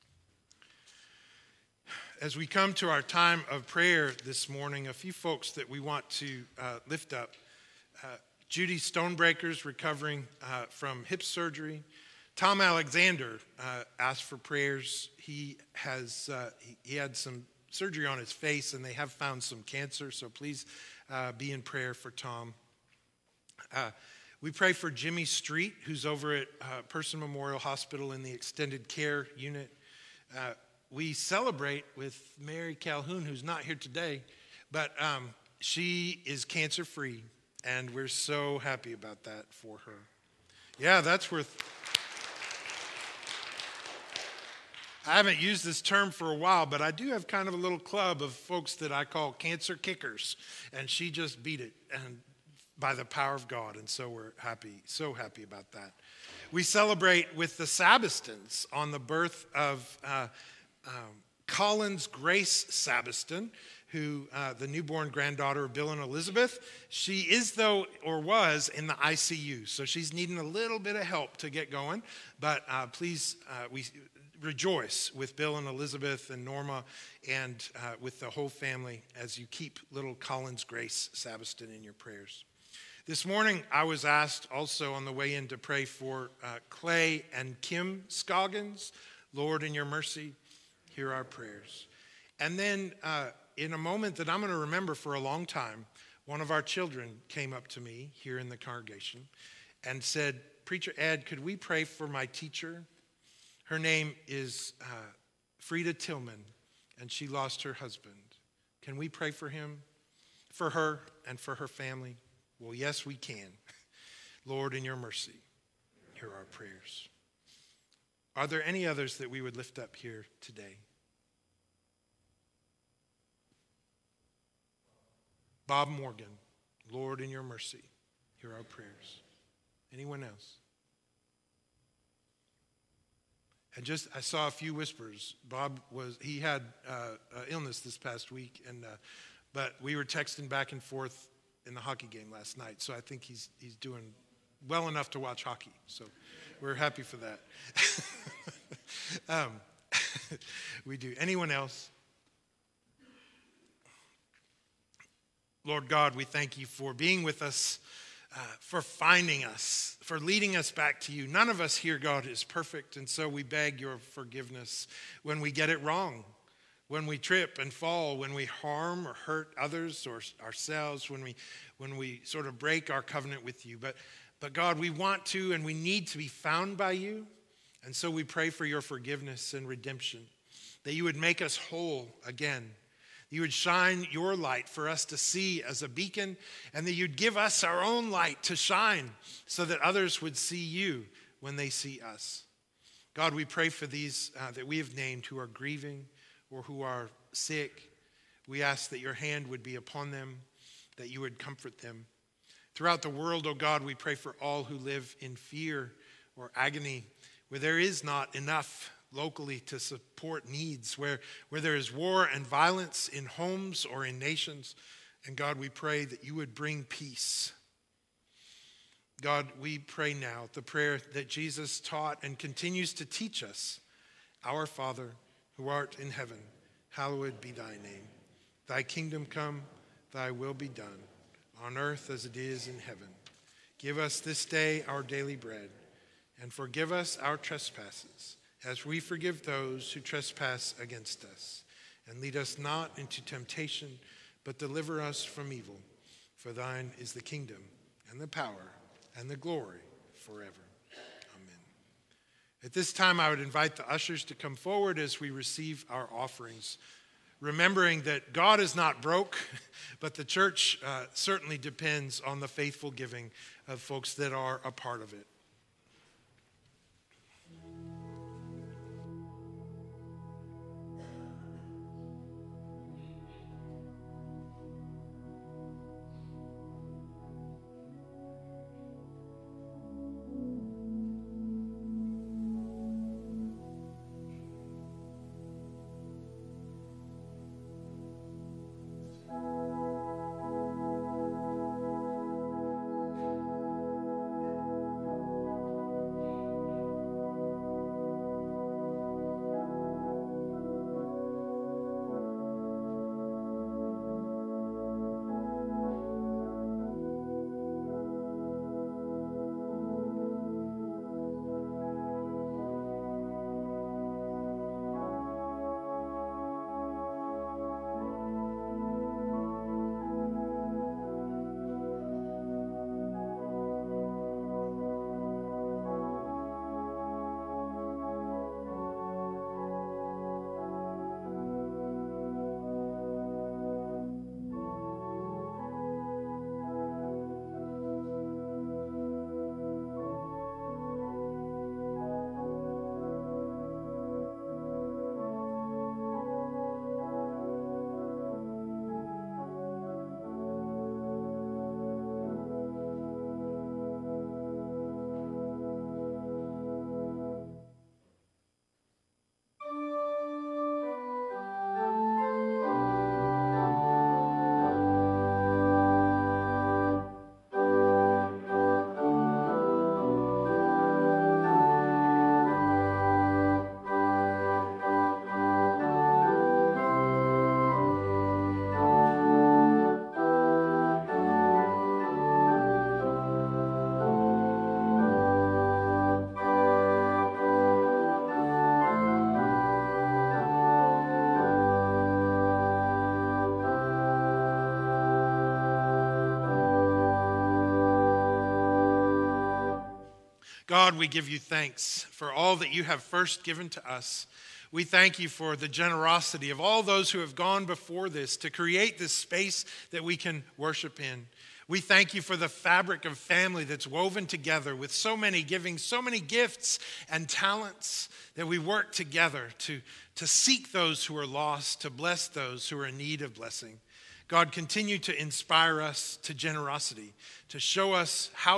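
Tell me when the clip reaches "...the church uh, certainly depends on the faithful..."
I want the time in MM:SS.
04:20.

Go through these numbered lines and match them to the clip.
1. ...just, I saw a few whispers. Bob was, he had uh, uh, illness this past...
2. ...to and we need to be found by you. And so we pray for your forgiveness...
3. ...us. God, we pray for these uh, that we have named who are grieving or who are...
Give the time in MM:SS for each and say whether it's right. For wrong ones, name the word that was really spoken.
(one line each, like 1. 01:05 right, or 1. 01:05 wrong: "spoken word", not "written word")
1. 02:13 right
2. 02:55 right
3. 03:12 right.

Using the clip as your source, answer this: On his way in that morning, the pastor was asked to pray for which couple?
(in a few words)
Clay and Kim Scoggins.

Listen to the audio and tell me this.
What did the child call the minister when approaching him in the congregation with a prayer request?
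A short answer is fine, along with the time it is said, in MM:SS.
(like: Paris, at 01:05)
Preacher Ed, at 01:40.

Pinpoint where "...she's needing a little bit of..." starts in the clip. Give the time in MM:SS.
01:09.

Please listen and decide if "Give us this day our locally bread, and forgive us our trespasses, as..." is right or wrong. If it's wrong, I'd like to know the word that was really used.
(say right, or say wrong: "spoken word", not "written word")
wrong: "daily", not "locally".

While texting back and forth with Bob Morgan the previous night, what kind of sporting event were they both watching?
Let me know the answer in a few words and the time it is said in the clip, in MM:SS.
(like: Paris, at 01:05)
Hockey game, at 02:21.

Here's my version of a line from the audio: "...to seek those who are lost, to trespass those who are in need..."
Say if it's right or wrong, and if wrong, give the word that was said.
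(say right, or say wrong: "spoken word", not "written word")
wrong: "bless", not "trespass".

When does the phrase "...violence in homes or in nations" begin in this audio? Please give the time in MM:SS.
03:32.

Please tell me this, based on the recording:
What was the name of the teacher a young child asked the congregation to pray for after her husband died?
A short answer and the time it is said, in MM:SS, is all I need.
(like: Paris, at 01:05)
Frida Tillman, at 01:45.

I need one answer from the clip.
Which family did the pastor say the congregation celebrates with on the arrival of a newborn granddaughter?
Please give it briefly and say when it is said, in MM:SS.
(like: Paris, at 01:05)
Sabistons, at 00:57.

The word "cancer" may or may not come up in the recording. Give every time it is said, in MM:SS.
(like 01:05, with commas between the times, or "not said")
00:19, 00:36, 00:49.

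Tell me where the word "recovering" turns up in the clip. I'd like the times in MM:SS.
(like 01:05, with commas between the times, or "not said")
00:09.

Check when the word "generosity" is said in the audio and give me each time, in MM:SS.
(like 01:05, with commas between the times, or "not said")
06:45, 07:06.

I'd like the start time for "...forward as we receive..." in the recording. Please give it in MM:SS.
04:14.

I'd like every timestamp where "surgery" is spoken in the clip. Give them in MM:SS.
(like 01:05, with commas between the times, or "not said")
00:11, 00:17.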